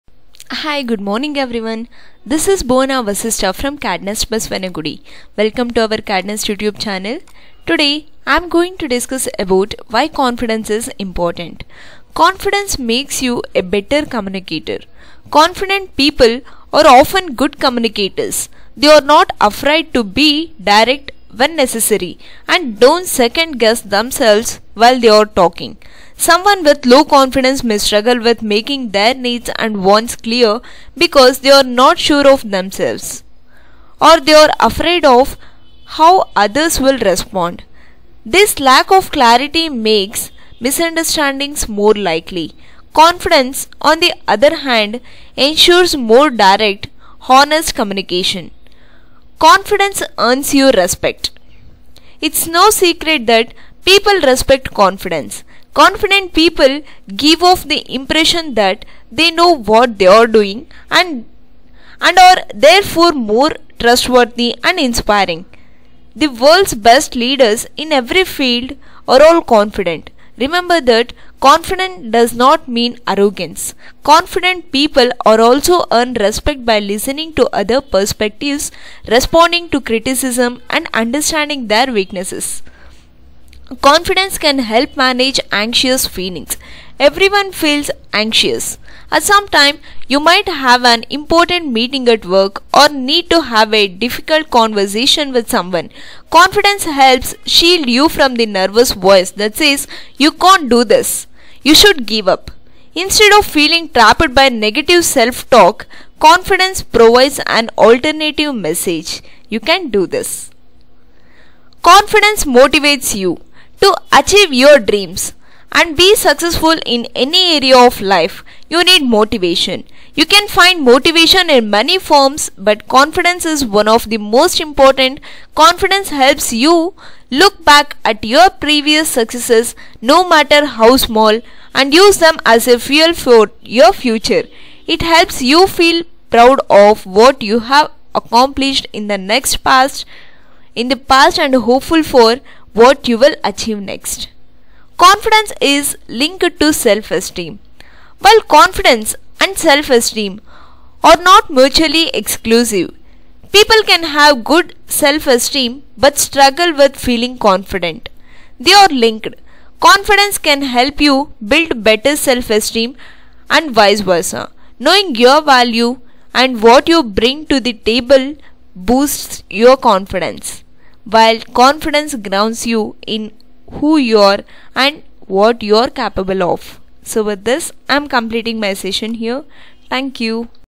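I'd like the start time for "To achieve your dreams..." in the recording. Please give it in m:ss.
1:53.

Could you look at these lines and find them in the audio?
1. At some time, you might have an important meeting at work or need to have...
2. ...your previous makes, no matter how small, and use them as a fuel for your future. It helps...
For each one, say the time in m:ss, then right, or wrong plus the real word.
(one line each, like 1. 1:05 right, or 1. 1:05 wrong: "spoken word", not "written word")
1. 1:29 right
2. 2:08 wrong: "successes", not "makes".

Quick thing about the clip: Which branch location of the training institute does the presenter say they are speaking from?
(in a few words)
Basavanagudi.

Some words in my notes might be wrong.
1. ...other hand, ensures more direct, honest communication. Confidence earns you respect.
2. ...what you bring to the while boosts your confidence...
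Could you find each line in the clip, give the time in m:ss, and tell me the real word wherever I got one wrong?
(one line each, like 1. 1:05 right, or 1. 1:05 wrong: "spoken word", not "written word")
1. 0:44 right
2. 2:46 wrong: "table", not "while".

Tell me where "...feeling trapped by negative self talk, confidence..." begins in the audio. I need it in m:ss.
1:43.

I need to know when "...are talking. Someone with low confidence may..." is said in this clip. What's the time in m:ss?
0:25.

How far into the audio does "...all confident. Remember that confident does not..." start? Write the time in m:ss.
1:09.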